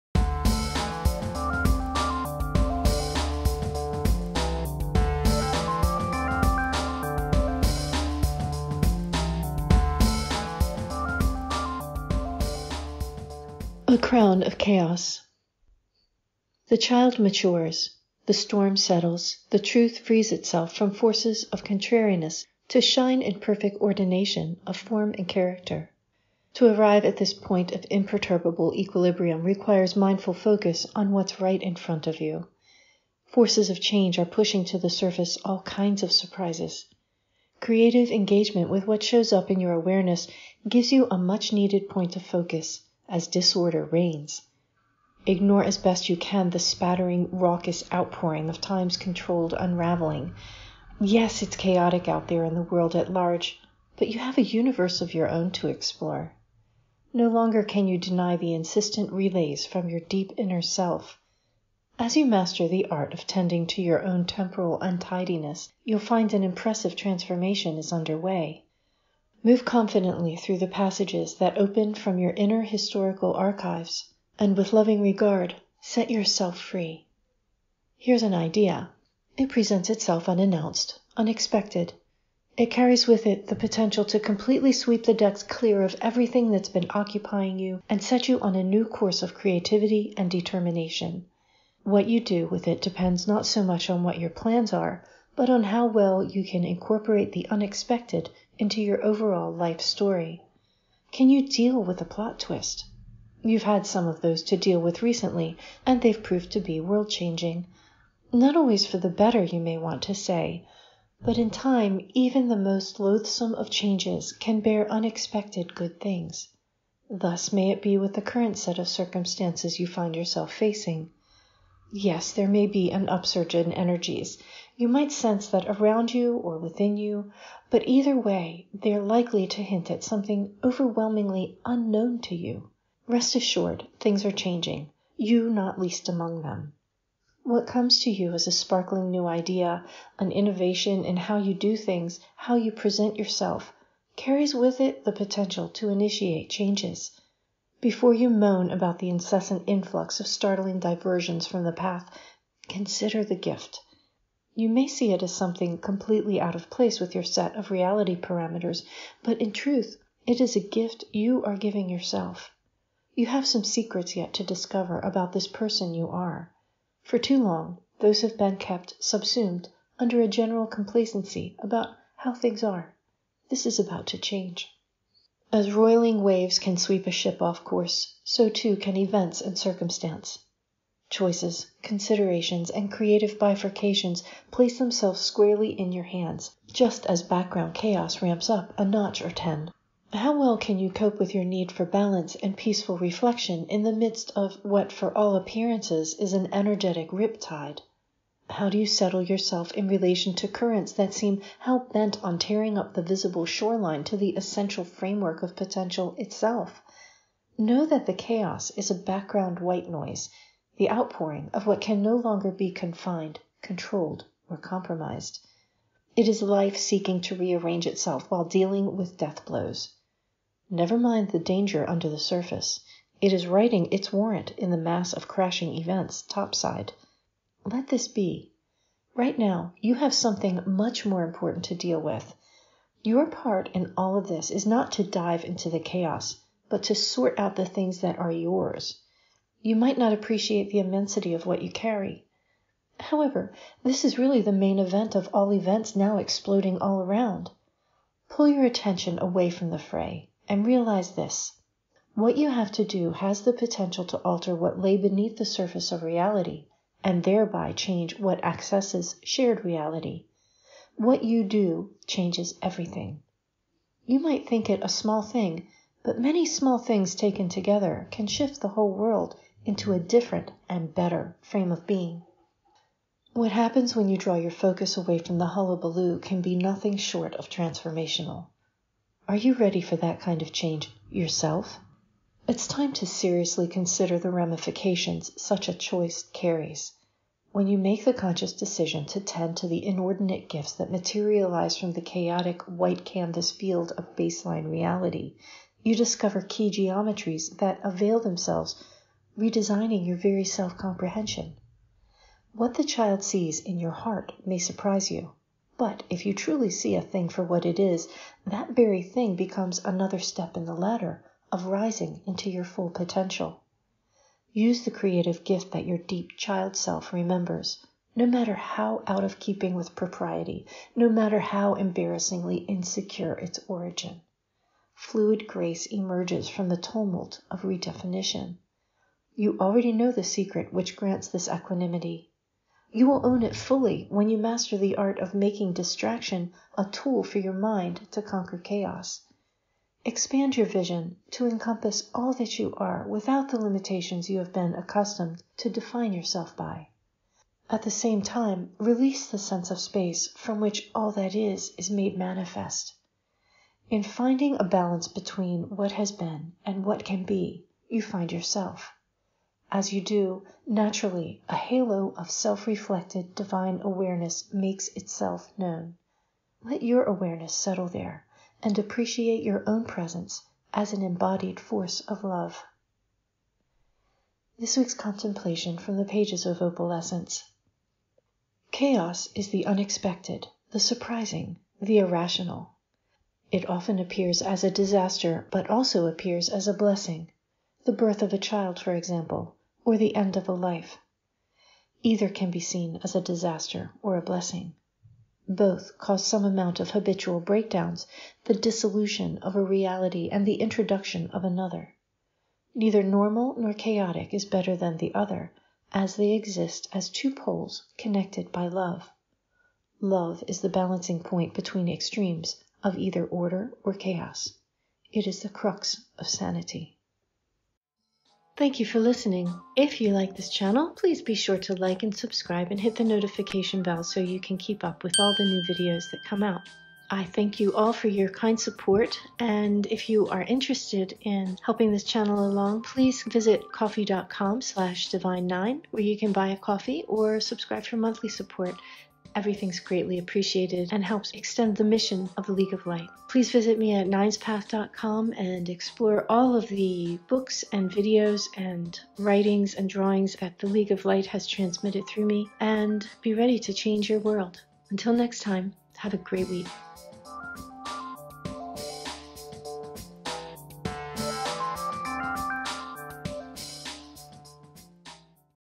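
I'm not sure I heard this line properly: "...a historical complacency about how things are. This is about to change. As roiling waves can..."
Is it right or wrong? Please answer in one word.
wrong.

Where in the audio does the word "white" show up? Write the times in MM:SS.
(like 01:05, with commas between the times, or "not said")
03:29, 04:52.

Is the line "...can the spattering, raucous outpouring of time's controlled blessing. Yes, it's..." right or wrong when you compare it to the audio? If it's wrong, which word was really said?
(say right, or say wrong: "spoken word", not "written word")
wrong: "unraveling", not "blessing".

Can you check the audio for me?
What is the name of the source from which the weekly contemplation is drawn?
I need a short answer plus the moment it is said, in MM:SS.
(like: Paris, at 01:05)
Opalescence, at 06:16.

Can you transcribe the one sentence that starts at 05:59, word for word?
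As you do, naturally, a halo of self reflected divine awareness makes itself known.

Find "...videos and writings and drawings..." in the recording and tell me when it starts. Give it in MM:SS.
07:27.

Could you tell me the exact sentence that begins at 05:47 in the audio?
At the same time, release the sense of space from which all that is is made manifest.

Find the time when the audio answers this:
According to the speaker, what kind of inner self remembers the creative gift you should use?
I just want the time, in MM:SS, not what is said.
05:15.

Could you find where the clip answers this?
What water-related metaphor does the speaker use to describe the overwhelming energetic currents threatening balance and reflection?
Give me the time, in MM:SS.
03:17.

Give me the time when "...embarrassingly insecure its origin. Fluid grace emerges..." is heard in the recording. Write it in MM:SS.
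05:21.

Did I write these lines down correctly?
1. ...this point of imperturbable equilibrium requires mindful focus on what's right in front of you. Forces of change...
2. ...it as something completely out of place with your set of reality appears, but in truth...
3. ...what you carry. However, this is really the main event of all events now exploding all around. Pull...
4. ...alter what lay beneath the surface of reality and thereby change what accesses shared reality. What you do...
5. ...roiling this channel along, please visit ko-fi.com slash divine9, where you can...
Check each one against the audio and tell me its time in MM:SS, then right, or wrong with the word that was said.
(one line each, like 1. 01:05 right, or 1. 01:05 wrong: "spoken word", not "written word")
1. 00:27 right
2. 02:35 wrong: "parameters", not "appears"
3. 04:01 right
4. 04:14 right
5. 07:11 wrong: "helping", not "roiling".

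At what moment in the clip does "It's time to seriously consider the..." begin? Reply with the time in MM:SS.
04:42.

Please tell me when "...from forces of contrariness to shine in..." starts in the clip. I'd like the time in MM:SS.
00:20.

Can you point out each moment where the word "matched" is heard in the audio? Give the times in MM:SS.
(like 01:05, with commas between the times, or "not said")
not said.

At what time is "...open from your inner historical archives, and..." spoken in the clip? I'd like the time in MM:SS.
01:11.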